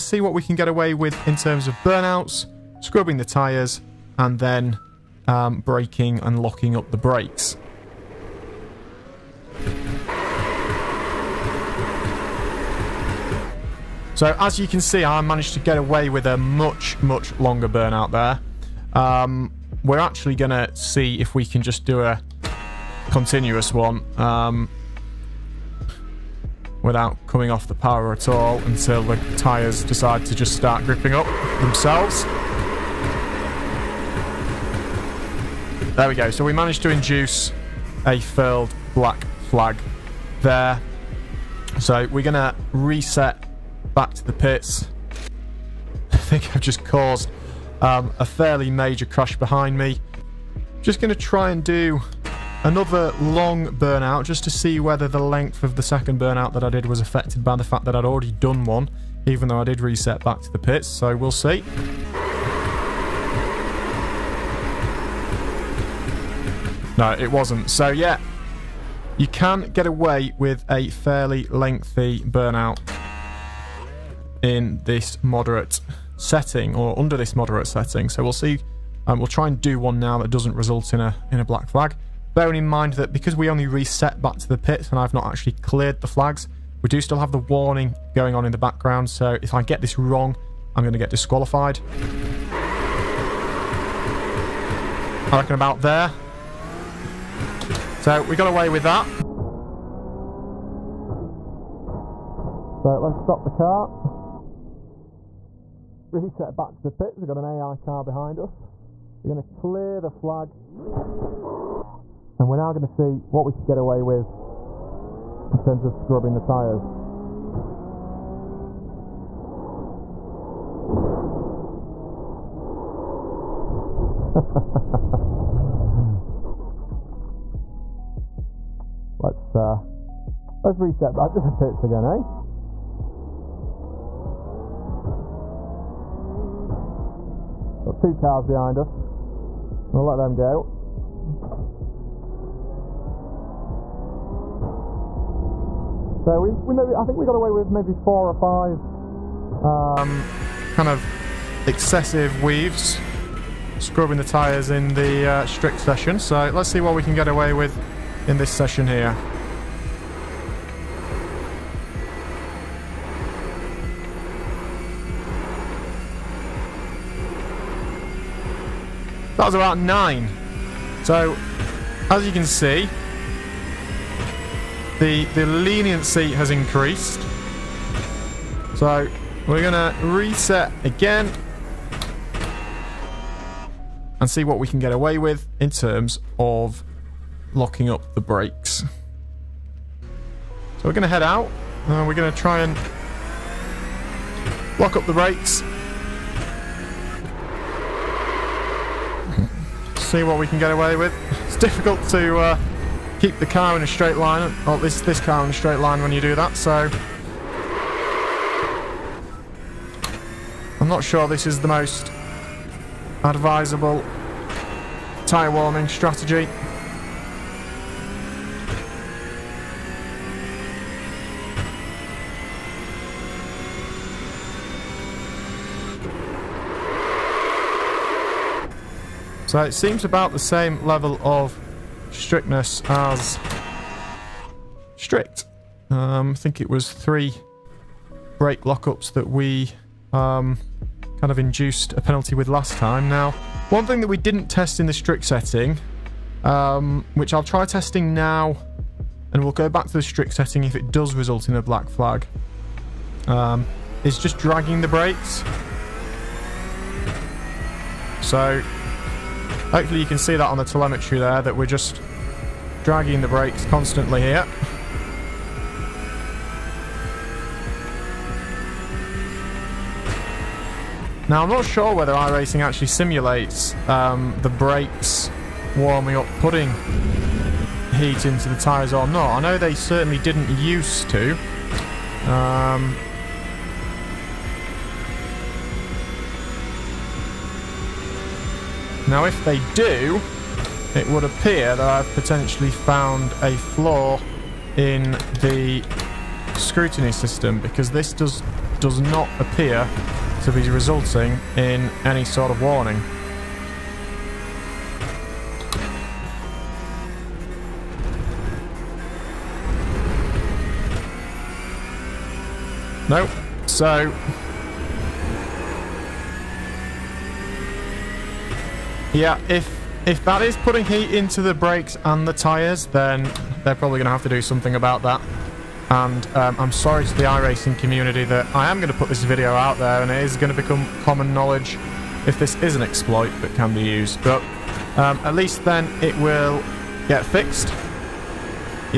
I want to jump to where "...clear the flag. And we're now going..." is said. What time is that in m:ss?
1:49.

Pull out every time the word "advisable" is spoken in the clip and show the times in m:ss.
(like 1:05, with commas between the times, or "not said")
3:33.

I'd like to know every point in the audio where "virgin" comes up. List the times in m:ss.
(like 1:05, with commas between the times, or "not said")
not said.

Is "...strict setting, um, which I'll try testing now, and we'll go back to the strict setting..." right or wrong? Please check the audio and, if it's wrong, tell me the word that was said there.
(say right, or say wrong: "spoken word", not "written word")
right.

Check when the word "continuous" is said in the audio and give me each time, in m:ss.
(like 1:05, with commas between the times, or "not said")
0:23.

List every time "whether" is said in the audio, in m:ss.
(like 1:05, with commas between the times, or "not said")
0:54, 4:31.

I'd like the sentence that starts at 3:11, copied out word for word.
and we're going to try and lock up the brakes.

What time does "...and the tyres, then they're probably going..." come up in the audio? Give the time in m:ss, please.
5:22.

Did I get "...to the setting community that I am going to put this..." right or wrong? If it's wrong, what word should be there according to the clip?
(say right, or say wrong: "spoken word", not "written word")
wrong: "iRacing", not "setting".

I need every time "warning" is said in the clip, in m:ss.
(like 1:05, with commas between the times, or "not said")
1:27, 5:02.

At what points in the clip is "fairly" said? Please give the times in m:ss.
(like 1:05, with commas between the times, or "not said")
0:48, 1:10.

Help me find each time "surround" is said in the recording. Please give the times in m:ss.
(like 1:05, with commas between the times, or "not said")
not said.